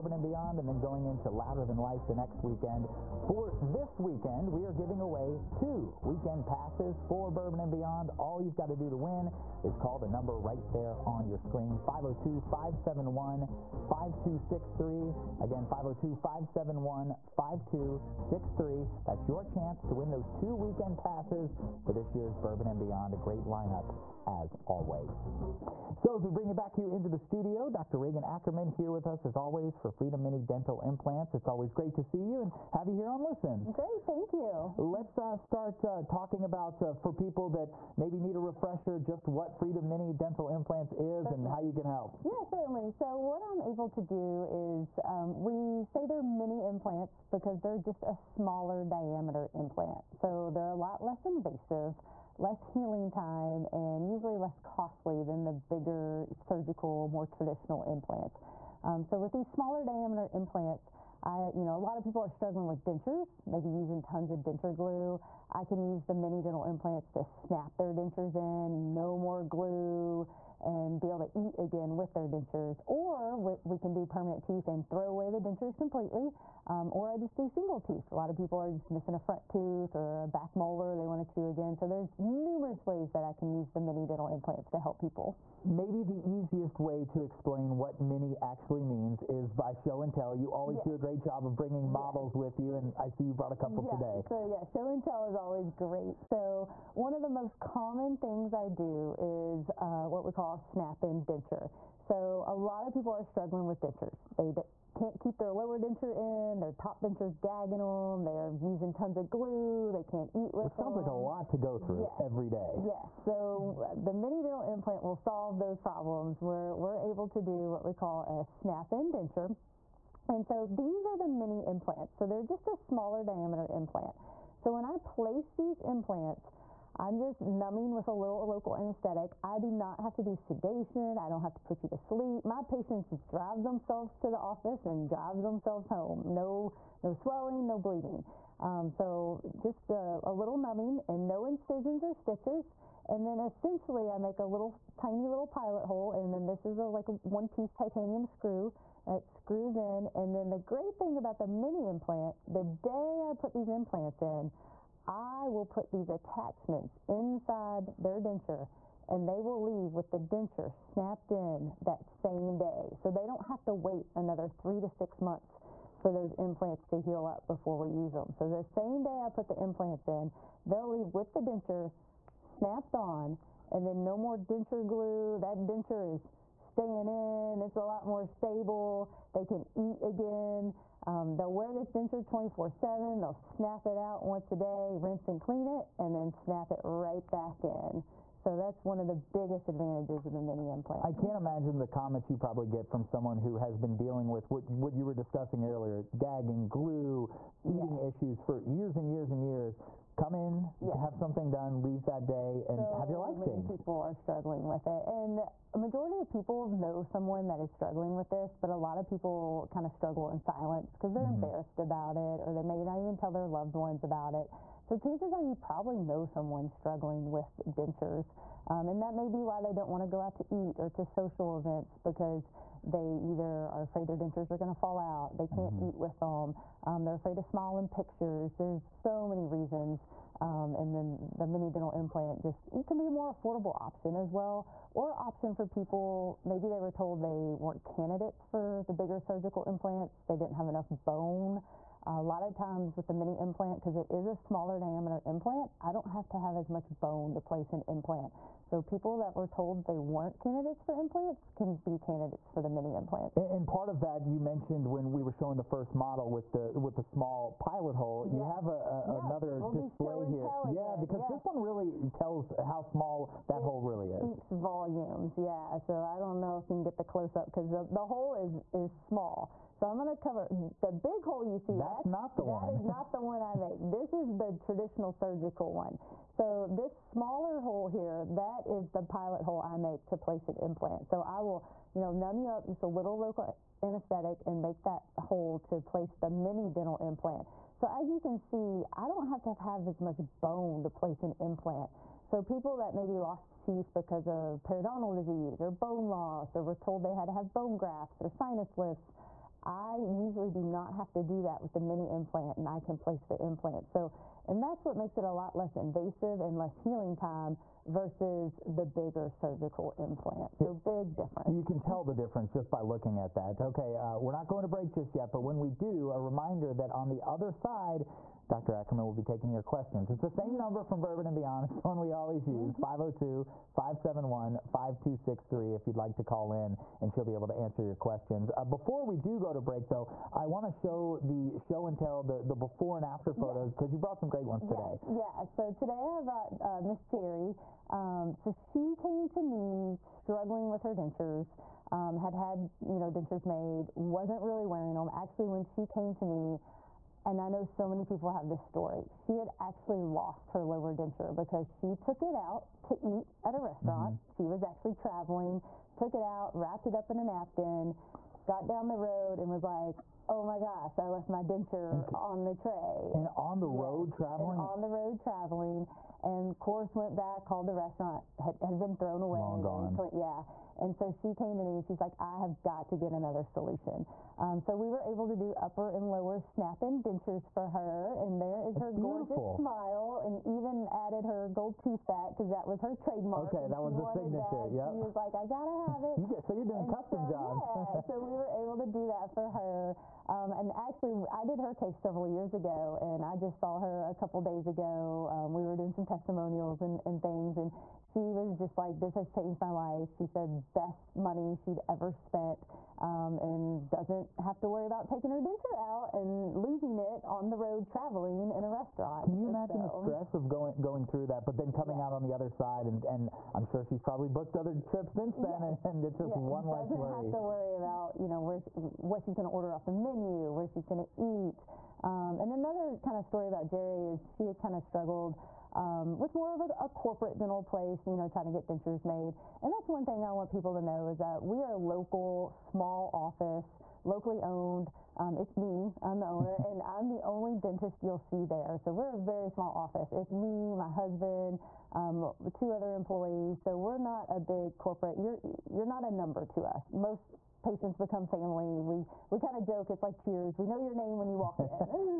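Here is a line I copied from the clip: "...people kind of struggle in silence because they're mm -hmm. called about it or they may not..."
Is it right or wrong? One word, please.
wrong.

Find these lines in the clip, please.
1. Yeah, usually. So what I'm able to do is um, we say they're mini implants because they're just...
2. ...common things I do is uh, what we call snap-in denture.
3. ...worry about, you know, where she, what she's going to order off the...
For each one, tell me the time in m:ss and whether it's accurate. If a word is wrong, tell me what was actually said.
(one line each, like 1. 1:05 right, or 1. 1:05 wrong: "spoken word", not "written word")
1. 0:42 wrong: "certainly", not "usually"
2. 1:37 right
3. 6:57 right.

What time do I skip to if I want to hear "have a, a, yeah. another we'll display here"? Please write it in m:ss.
4:18.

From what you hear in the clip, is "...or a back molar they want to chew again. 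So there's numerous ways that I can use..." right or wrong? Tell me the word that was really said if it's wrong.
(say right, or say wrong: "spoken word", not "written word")
right.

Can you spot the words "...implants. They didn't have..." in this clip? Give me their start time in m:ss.
3:59.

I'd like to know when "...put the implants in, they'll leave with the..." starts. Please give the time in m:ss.
2:49.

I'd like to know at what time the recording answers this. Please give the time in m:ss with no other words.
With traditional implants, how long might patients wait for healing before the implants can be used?
2:44.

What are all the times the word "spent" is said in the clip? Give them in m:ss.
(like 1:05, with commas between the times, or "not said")
6:42.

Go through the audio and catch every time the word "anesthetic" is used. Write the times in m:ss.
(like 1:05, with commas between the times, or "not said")
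2:08, 4:43.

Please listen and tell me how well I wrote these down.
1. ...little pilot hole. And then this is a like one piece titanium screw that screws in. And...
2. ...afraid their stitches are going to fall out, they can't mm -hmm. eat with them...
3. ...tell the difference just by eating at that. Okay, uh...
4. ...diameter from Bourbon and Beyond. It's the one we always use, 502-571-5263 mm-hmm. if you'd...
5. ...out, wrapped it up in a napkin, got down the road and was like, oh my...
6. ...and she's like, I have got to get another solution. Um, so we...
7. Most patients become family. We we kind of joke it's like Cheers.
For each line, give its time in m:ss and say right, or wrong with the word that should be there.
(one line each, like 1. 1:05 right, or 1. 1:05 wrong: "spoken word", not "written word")
1. 2:25 right
2. 3:43 wrong: "dentures", not "stitches"
3. 5:11 wrong: "looking", not "eating"
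4. 5:20 wrong: "number", not "diameter"
5. 5:56 right
6. 6:11 right
7. 7:26 right.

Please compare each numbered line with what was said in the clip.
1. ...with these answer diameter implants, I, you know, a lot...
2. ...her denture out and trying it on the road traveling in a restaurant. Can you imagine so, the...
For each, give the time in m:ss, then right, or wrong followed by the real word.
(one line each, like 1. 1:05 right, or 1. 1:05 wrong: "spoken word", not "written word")
1. 0:59 wrong: "smaller", not "answer"
2. 6:45 wrong: "losing", not "trying".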